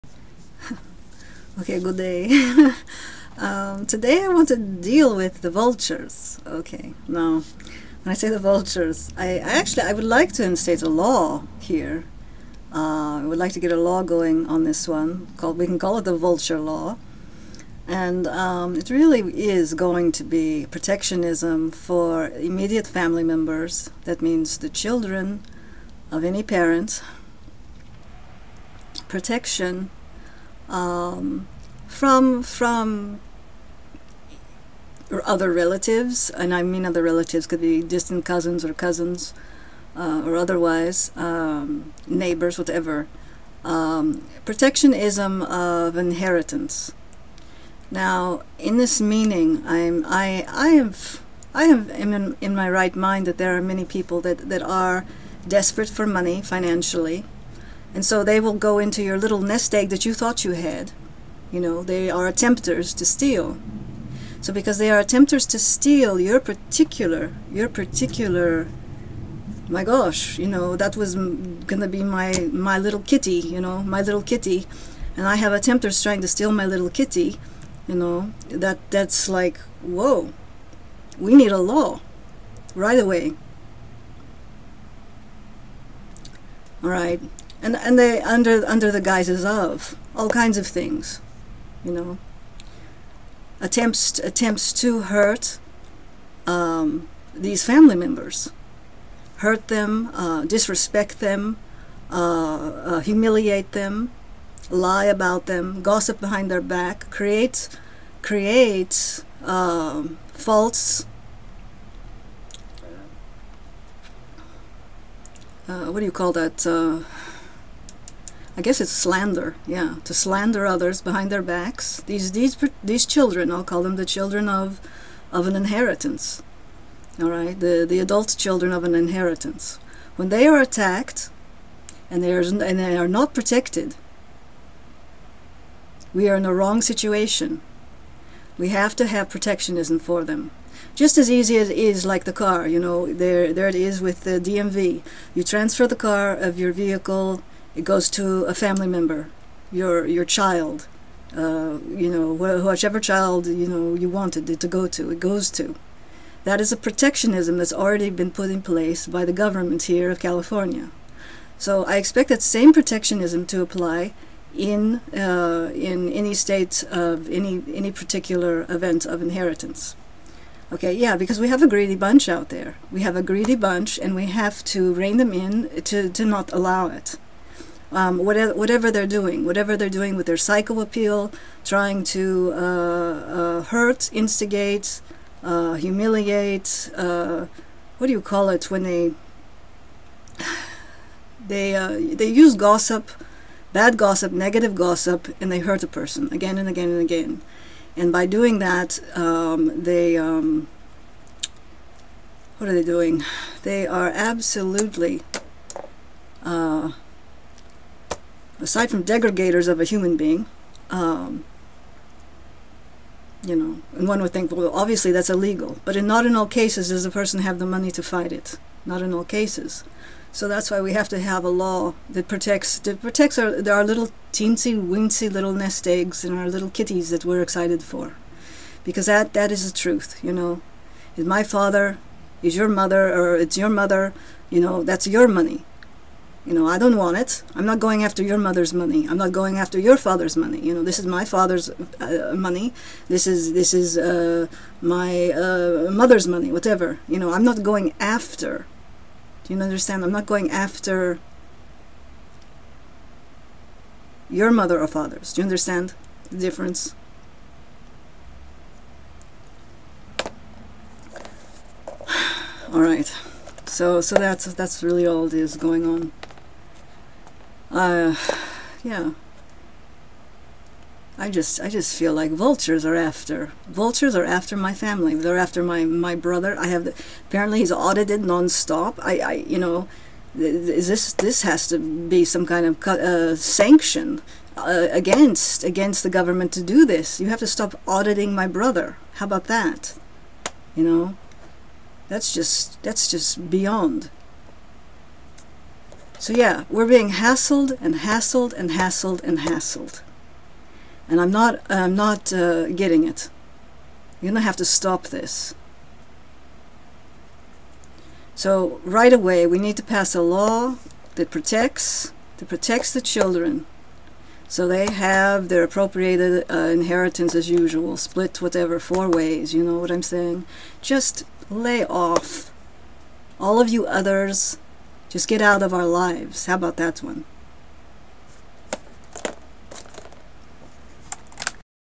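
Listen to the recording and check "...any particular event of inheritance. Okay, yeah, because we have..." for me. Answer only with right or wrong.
right.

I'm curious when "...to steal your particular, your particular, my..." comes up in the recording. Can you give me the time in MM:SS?
01:05.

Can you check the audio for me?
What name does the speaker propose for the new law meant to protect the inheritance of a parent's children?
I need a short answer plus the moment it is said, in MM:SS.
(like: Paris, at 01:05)
the vulture law, at 00:16.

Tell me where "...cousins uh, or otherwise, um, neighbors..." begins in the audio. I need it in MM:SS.
00:38.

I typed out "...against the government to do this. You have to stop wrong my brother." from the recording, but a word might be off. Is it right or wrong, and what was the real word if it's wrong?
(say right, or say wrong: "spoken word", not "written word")
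wrong: "auditing", not "wrong".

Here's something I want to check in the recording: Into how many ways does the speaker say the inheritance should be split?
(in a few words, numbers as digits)
4.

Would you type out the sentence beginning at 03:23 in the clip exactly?
They are absolutely uh, aside from degradators of a human being, um, you know, and one would think, well, obviously that's illegal.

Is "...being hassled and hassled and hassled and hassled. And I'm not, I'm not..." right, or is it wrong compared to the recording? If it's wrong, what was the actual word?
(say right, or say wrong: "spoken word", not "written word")
right.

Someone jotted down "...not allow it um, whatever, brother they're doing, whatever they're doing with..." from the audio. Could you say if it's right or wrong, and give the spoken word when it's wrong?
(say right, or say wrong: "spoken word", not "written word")
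wrong: "whatever", not "brother".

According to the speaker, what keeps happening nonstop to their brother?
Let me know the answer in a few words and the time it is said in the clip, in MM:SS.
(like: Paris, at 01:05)
audited, at 04:37.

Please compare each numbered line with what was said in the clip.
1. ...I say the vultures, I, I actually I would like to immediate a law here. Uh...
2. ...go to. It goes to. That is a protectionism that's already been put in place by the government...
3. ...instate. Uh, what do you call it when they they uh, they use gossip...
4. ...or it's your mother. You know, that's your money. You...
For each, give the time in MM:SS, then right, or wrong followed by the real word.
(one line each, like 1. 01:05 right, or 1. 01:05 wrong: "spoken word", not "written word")
1. 00:08 wrong: "instate", not "immediate"
2. 02:34 right
3. 03:05 wrong: "humiliate", not "instate"
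4. 03:53 right.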